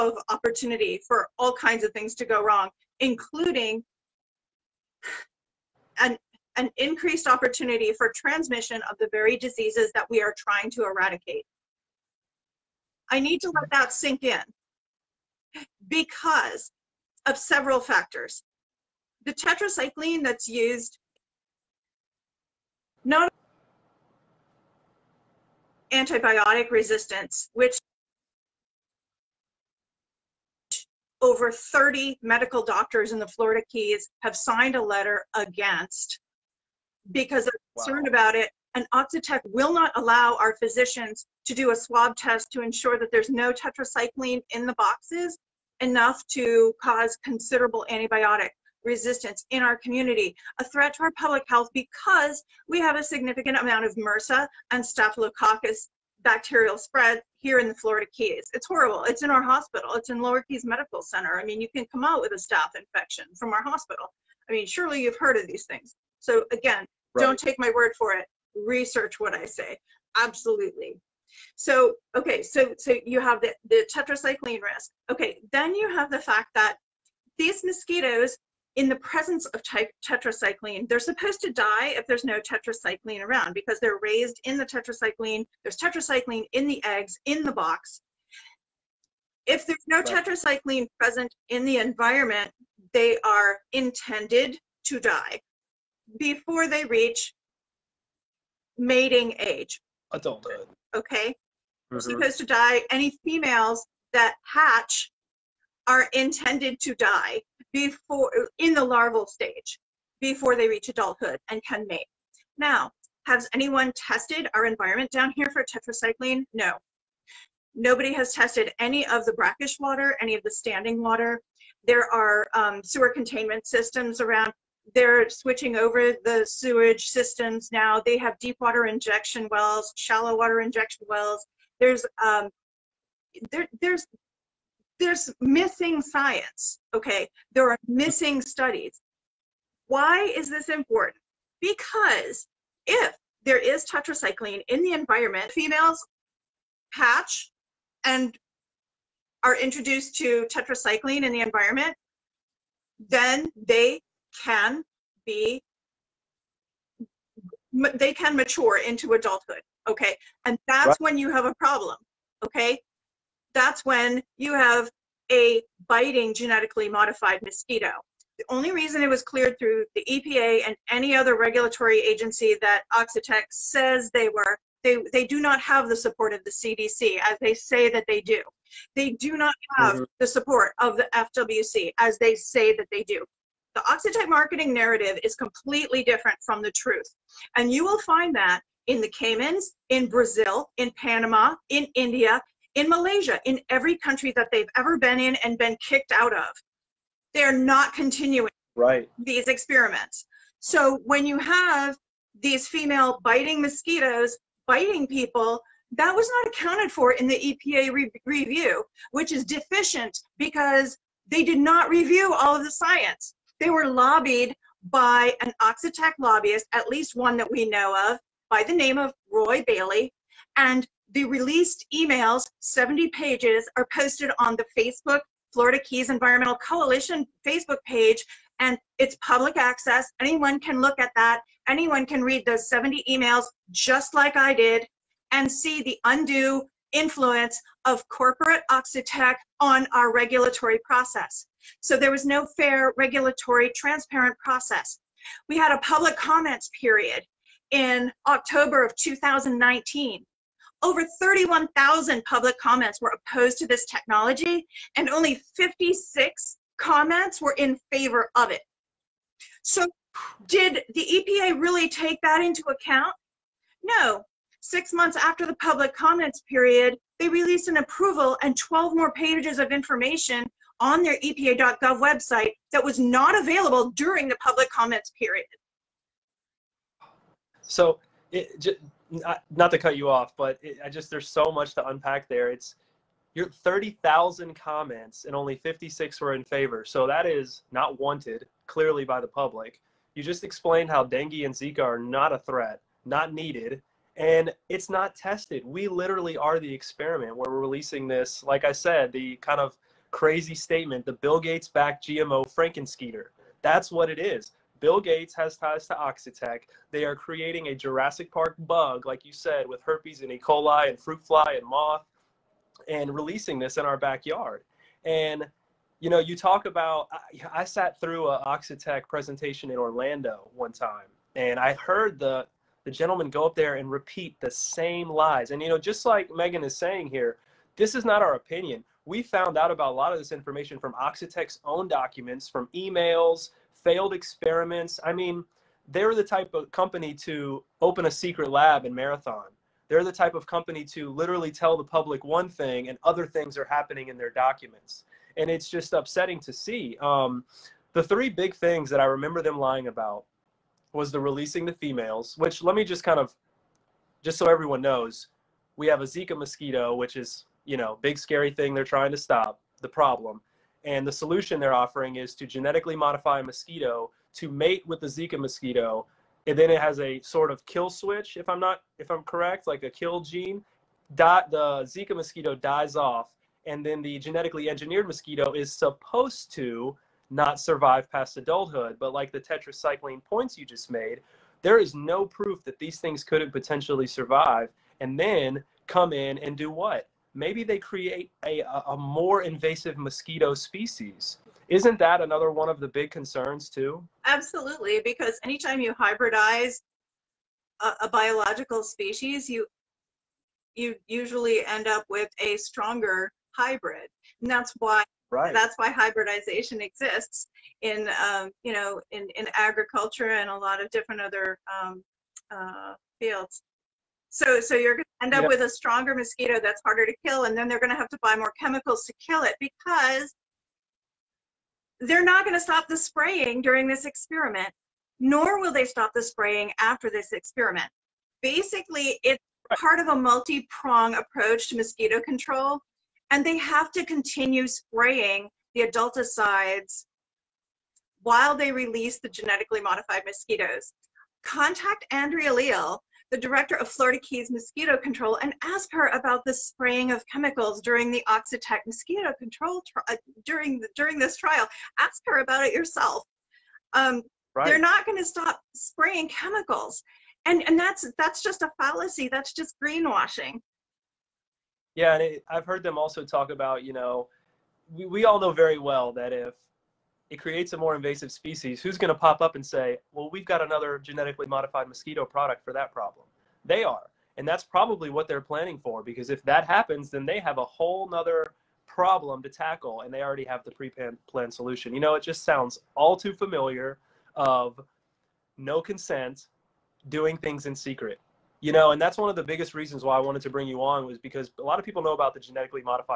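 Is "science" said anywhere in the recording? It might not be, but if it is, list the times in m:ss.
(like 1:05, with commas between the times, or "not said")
2:16, 3:32.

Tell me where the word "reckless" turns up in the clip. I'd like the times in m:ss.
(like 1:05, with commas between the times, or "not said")
not said.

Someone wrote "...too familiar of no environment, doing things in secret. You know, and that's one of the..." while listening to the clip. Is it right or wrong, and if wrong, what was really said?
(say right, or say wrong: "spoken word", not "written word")
wrong: "consent", not "environment".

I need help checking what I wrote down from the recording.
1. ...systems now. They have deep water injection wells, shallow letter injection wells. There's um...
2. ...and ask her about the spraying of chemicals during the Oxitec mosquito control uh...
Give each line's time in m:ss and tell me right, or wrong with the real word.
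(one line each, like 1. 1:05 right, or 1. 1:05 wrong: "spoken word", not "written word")
1. 2:07 wrong: "water", not "letter"
2. 7:25 right.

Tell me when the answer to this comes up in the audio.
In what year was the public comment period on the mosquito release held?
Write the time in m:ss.
4:08.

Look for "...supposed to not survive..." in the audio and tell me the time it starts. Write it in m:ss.
6:15.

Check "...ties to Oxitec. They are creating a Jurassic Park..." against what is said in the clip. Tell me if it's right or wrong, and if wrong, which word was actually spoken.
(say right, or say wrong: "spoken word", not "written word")
right.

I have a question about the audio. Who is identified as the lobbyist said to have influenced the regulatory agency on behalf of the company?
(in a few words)
Roy Bailey.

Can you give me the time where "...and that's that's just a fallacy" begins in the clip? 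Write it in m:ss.
7:37.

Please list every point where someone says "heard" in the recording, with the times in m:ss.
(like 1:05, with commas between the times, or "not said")
1:05, 5:21, 7:42.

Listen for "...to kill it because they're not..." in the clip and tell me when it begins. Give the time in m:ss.
6:59.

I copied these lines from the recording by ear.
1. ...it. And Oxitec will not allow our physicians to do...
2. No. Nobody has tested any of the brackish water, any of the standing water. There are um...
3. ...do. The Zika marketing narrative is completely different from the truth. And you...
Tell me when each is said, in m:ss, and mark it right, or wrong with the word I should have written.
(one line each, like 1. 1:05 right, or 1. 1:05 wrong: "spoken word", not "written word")
1. 0:38 right
2. 1:56 right
3. 3:03 wrong: "Oxitec", not "Zika".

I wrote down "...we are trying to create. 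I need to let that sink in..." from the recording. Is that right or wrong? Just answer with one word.
wrong.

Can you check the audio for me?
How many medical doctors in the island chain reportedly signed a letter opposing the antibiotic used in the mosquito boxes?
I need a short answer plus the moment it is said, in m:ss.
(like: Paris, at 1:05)
over 30, at 0:31.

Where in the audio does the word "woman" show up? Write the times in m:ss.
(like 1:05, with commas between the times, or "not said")
not said.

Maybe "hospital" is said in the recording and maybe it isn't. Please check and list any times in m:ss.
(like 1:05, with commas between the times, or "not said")
0:59, 1:03.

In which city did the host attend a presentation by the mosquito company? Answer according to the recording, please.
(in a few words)
Orlando.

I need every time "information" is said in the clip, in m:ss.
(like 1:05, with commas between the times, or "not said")
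4:29, 5:30.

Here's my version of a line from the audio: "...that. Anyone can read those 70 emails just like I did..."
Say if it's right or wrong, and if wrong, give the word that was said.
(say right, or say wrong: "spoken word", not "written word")
right.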